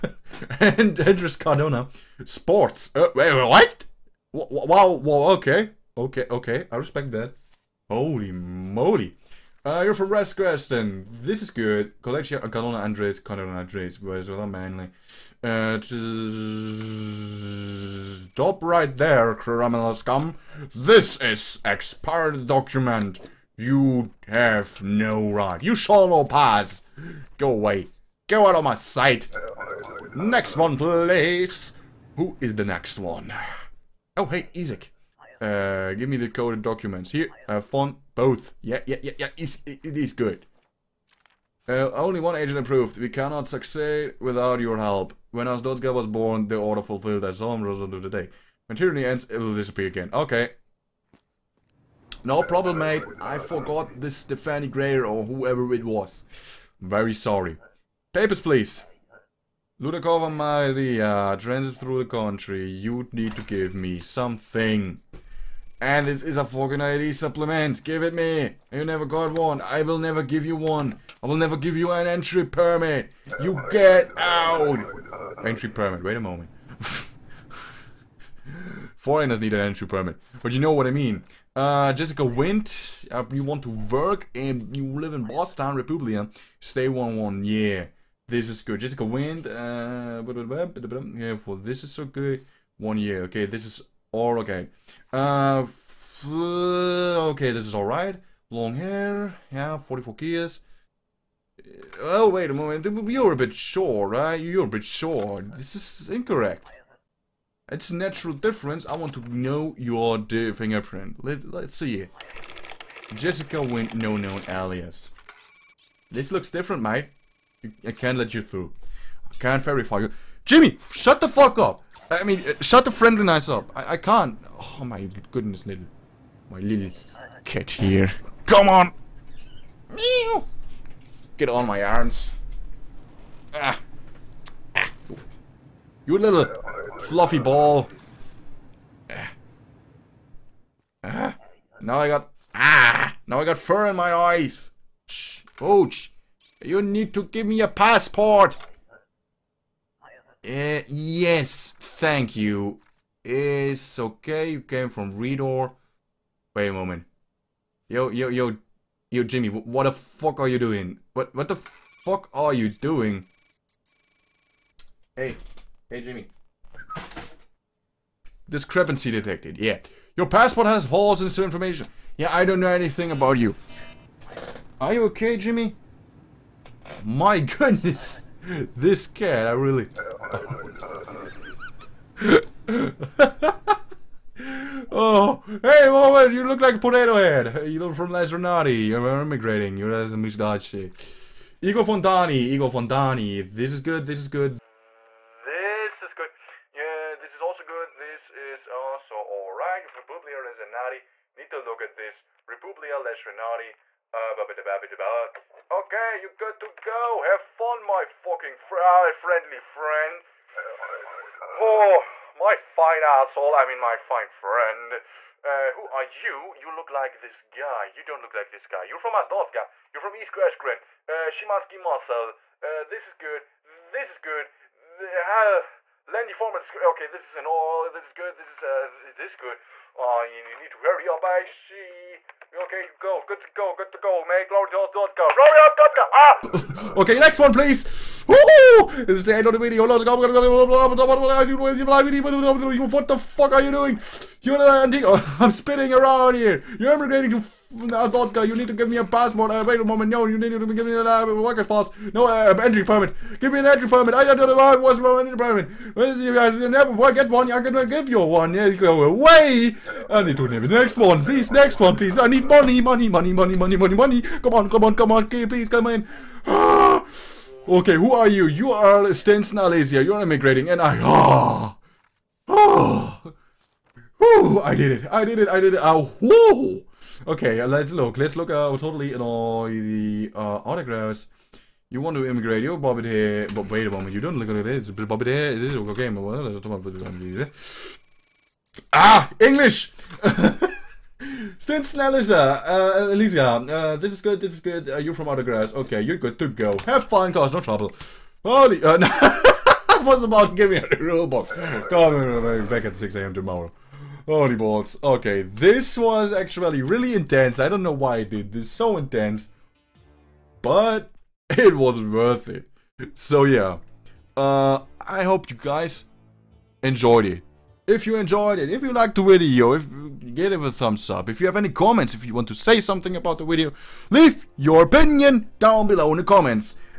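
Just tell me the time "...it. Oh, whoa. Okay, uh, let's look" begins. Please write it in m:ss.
4:35.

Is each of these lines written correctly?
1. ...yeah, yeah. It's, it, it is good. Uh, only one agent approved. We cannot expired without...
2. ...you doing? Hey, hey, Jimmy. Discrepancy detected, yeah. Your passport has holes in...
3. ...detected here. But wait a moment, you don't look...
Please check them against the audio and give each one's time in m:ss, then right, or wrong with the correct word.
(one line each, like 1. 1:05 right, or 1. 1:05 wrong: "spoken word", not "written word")
1. 0:39 wrong: "succeed", not "expired"
2. 2:42 right
3. 4:42 wrong: "bobbed", not "detected".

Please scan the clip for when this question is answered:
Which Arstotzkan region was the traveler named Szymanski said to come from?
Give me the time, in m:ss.
3:40.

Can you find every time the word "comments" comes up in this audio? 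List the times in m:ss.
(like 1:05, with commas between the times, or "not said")
5:21, 5:26.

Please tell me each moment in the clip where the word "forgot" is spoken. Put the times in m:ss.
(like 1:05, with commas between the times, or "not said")
0:53.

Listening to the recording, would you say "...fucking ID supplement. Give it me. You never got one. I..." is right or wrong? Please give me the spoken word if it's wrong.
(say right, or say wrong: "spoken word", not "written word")
right.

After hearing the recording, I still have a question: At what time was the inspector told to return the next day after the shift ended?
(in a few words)
6 a.m.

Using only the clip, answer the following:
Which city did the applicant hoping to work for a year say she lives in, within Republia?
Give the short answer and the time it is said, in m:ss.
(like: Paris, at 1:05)
Boston, at 1:25.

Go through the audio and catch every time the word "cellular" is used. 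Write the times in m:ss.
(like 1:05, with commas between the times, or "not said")
not said.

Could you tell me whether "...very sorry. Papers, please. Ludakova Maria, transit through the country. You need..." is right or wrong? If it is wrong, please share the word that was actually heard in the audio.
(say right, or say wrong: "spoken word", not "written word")
right.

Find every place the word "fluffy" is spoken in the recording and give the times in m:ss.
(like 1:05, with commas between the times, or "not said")
2:17.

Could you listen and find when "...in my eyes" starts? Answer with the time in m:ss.
2:23.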